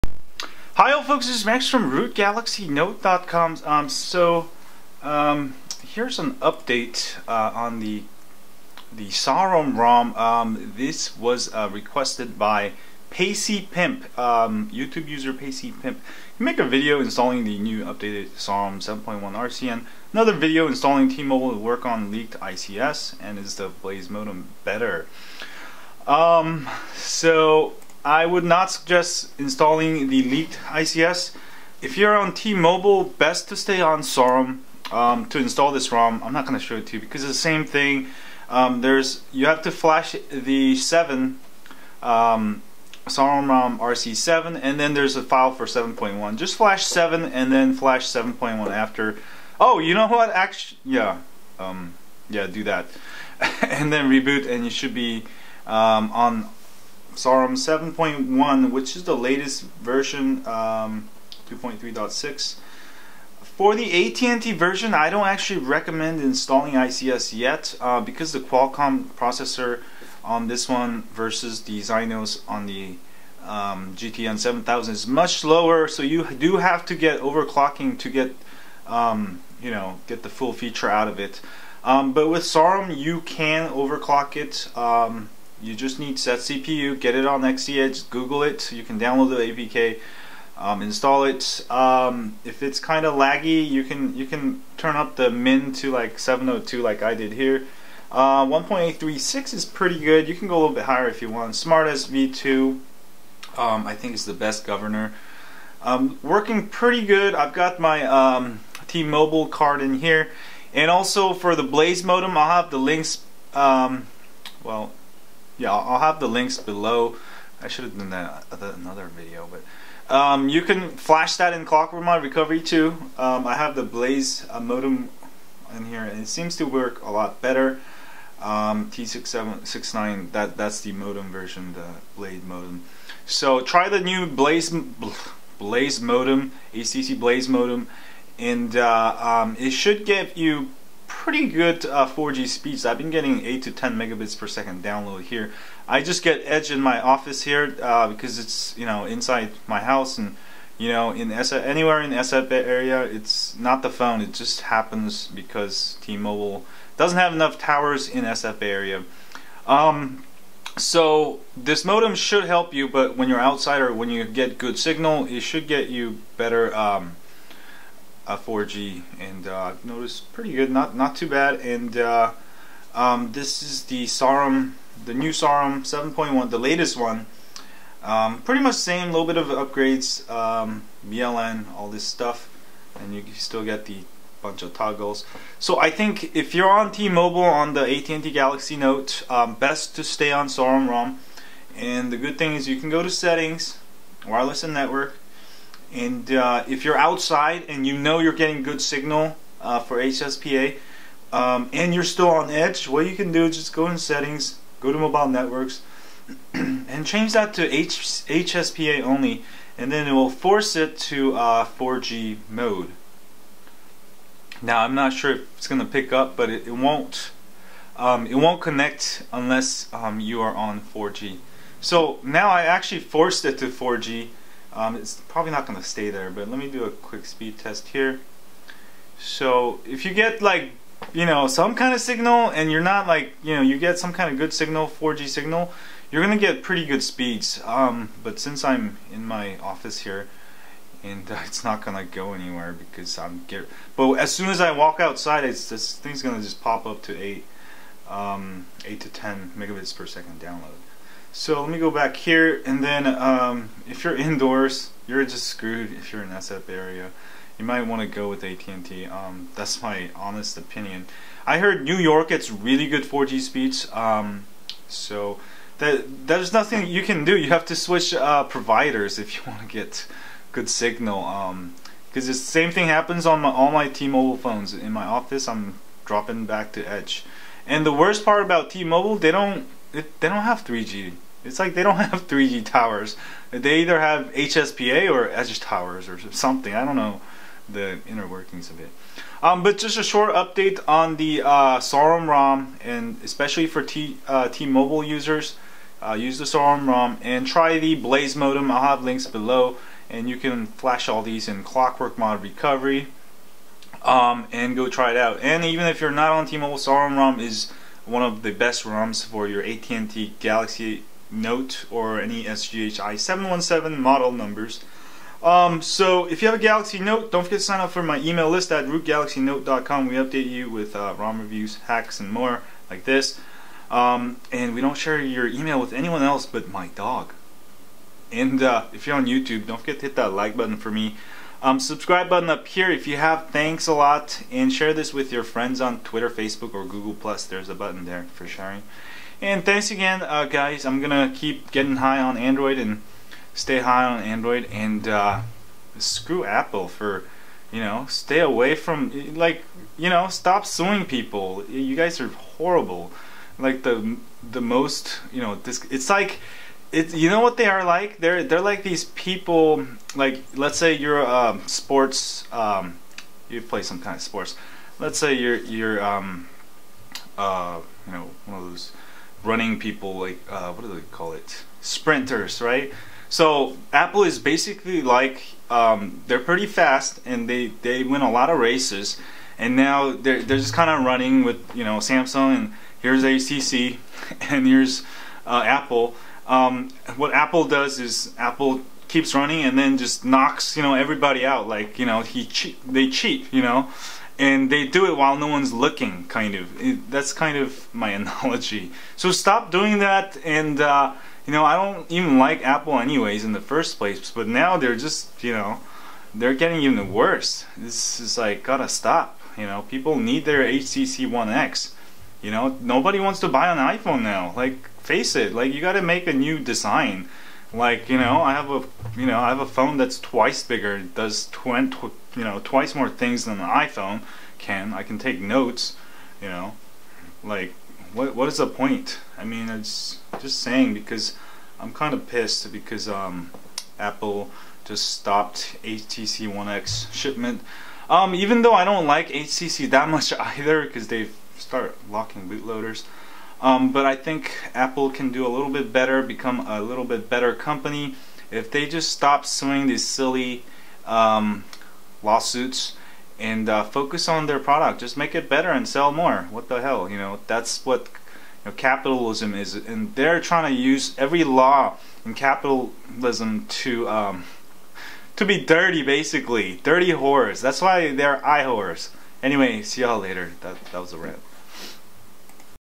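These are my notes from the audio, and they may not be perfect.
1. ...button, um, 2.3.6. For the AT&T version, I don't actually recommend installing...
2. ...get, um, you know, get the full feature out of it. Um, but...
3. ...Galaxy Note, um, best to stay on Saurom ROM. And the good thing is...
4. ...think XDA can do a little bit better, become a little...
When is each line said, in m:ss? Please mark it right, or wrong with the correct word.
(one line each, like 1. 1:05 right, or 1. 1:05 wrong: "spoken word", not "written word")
1. 0:59 wrong: "version", not "button"
2. 1:18 right
3. 3:08 right
4. 7:24 wrong: "Apple", not "XDA".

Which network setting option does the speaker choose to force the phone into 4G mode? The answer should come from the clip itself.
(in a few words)
HSPA only.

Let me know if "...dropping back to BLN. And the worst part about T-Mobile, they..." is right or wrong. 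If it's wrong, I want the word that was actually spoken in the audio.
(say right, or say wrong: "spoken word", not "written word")
wrong: "Edge", not "BLN".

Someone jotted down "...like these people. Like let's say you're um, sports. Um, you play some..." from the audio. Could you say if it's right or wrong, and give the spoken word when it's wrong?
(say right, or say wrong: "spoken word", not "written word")
right.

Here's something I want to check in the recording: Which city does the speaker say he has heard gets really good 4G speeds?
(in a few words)
New York.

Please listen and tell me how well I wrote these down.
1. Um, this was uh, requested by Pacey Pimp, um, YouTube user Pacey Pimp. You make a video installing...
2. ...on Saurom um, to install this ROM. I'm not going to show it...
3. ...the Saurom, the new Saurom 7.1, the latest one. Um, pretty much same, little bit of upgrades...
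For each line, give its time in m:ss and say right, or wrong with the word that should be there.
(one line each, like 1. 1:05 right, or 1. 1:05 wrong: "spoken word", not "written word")
1. 0:10 right
2. 0:33 right
3. 2:53 right.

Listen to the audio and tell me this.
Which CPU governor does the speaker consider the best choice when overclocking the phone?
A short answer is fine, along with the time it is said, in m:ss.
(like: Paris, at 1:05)
SmartassV2, at 1:41.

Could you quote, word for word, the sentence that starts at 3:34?
Now I'm not sure if it's going to pick up, but it, it won't.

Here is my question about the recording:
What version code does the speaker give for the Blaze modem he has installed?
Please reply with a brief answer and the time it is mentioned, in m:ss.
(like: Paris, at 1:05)
T6769, at 2:08.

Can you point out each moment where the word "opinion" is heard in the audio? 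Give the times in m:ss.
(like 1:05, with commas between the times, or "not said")
4:20.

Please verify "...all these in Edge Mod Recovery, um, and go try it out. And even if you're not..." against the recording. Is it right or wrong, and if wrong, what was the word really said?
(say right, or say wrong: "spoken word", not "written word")
wrong: "Clockwork", not "Edge".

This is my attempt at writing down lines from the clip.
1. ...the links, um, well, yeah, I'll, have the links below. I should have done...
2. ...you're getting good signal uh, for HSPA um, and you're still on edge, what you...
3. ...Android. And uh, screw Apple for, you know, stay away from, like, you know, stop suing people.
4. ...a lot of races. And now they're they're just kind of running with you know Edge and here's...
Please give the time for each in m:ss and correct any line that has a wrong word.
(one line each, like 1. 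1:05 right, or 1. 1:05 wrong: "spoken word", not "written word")
1. 1:52 right
2. 3:18 right
3. 5:44 right
4. 6:18 wrong: "Samsung", not "Edge".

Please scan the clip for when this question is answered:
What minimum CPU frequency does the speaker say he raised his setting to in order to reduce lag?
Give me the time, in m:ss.
1:36.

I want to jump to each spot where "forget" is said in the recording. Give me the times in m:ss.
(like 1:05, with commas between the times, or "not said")
5:17, 5:29.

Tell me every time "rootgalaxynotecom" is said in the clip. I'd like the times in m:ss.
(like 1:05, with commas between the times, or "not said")
0:01, 5:18.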